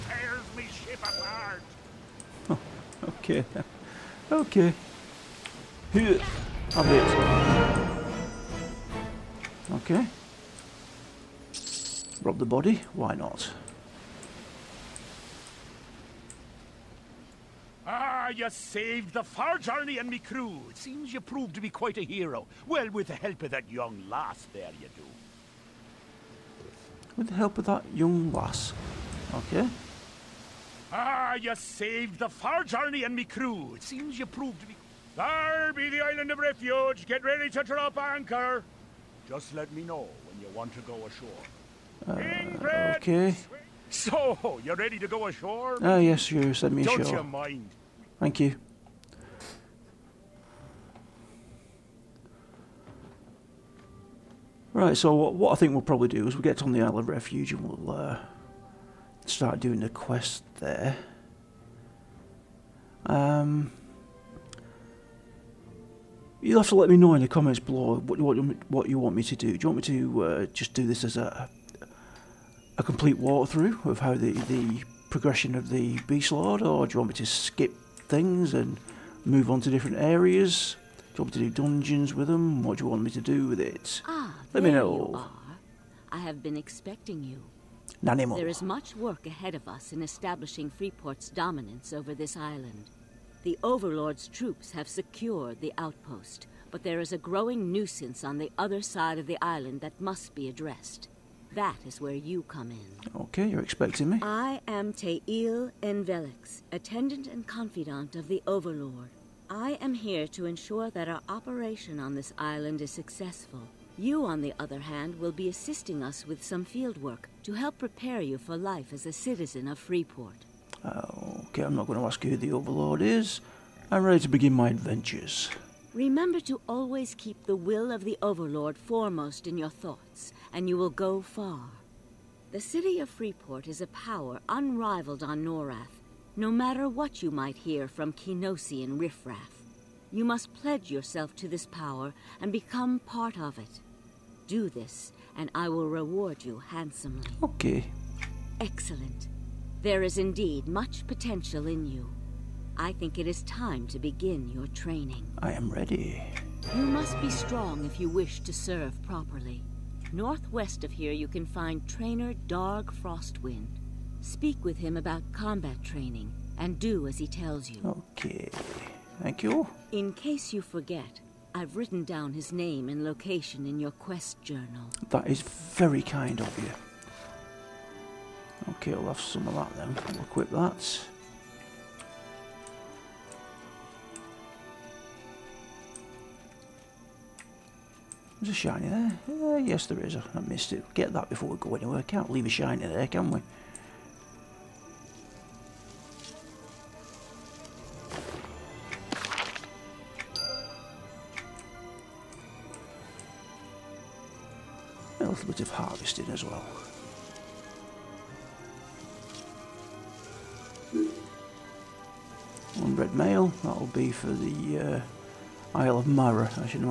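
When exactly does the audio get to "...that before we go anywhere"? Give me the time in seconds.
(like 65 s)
191 s.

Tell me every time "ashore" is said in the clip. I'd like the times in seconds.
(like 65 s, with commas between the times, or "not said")
41 s, 45 s.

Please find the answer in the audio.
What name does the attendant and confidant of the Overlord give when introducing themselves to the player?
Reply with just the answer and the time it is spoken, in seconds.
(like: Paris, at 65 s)
Tayil N'Velex, at 104 s.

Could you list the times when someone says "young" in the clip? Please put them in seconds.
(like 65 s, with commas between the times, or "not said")
23 s, 27 s.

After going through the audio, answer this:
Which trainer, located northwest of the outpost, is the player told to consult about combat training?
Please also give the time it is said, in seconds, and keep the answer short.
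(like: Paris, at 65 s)
Darg Frostwind, at 162 s.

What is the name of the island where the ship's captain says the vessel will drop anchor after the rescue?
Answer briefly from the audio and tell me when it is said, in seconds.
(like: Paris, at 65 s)
Island of Refuge, at 36 s.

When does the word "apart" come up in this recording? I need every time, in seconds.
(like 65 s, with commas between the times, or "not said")
1 s.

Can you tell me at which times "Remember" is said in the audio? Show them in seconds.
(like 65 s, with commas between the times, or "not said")
125 s.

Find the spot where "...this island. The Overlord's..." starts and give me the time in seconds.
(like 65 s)
92 s.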